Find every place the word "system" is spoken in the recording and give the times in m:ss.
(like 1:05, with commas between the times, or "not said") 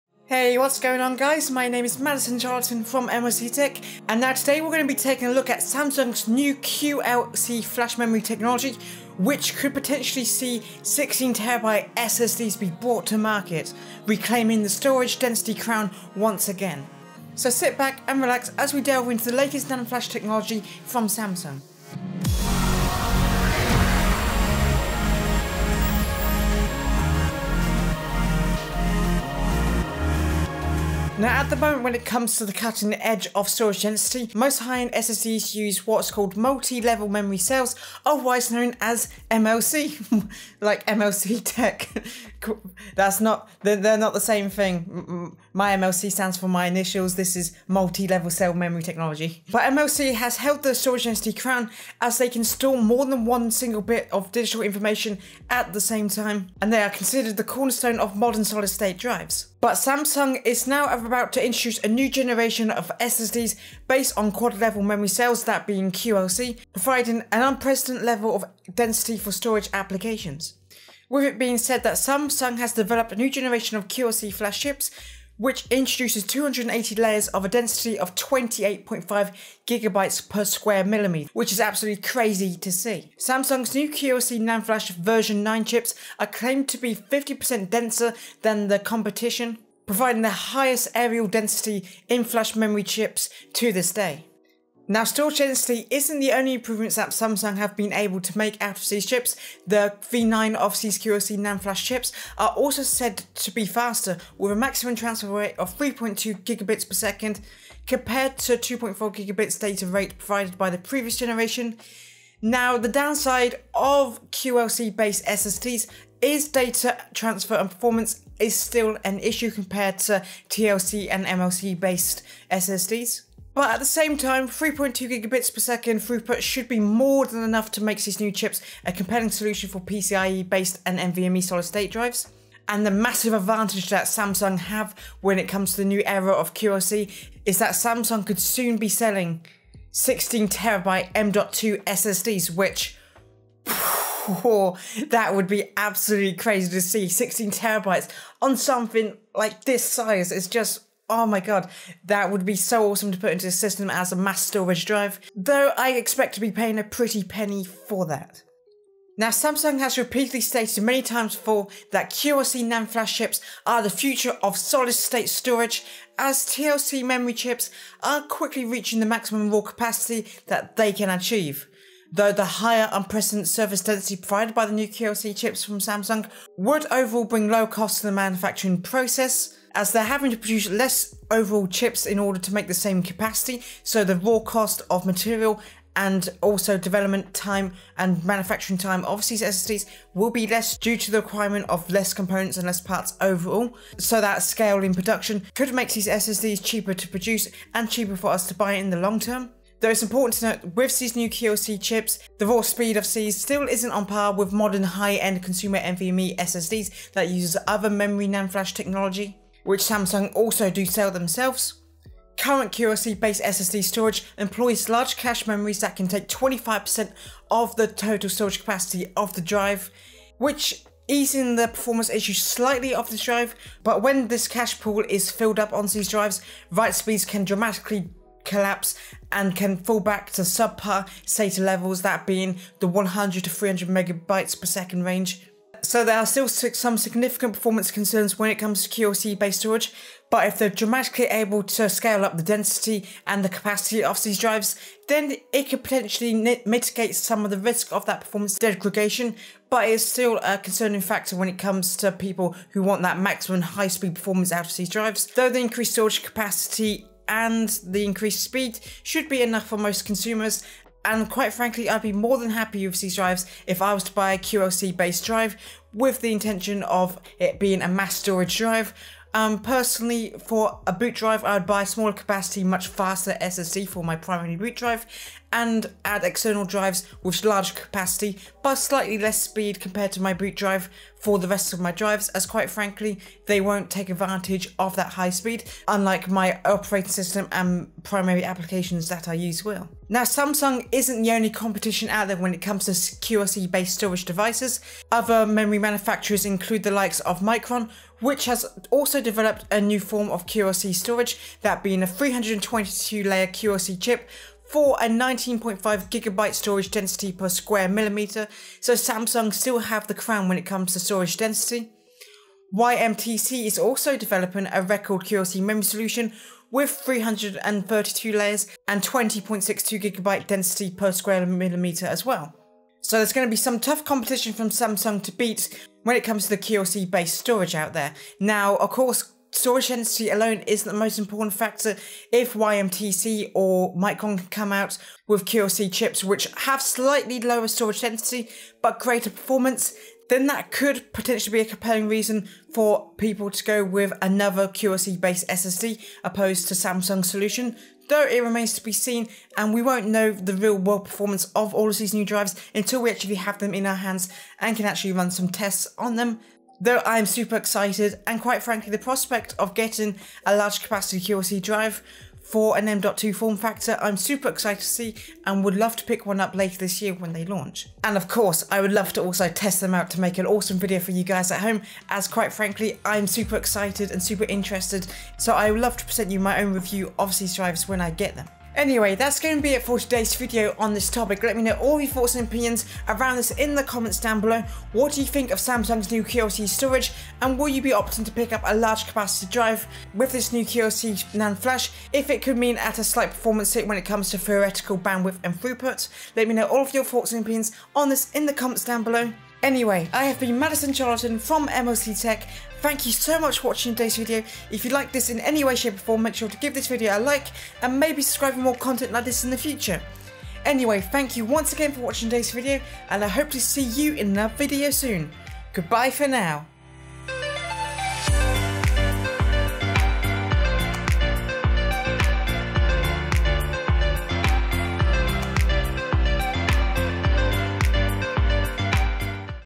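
2:33, 4:47.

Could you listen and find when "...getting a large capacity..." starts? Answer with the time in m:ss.
5:59.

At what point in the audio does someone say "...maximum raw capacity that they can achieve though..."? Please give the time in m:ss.
2:49.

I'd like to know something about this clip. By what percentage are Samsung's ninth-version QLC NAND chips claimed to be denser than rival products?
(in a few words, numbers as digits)
50%.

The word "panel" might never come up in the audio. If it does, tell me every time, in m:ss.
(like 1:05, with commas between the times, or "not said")
not said.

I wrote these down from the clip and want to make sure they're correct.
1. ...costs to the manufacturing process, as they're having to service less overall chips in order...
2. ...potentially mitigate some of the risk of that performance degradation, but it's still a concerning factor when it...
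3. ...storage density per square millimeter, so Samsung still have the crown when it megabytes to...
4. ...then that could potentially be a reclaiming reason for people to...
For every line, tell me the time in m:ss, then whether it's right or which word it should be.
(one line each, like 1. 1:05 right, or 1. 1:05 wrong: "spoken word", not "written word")
1. 2:57 wrong: "produce", not "service"
2. 4:05 right
3. 5:06 wrong: "comes", not "megabytes"
4. 5:40 wrong: "compelling", not "reclaiming".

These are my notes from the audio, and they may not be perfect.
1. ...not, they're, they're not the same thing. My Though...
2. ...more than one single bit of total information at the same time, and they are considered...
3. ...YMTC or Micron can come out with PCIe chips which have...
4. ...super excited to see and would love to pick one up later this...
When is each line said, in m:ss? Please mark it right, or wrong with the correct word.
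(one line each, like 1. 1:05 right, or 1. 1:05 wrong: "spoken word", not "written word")
1. 0:43 wrong: "MLC", not "Though"
2. 0:52 wrong: "digital", not "total"
3. 5:32 wrong: "QLC", not "PCIe"
4. 6:04 right.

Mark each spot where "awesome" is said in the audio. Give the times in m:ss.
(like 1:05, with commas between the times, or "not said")
2:32, 6:10.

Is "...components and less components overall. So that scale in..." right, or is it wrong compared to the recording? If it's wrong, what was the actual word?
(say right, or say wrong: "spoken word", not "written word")
wrong: "parts", not "components".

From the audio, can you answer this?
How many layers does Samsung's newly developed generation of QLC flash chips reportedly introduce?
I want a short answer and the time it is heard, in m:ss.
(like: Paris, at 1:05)
280, at 1:16.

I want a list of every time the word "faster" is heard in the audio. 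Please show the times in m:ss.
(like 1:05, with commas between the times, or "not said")
1:43, 4:32.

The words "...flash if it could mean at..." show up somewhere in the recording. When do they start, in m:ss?
6:31.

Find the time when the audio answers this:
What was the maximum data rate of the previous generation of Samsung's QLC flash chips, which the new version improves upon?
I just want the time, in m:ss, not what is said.
1:48.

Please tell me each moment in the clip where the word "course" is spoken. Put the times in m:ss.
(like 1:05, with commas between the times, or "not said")
5:28, 6:08.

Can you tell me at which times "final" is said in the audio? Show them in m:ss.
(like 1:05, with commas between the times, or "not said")
not said.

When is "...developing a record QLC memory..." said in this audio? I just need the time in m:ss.
5:14.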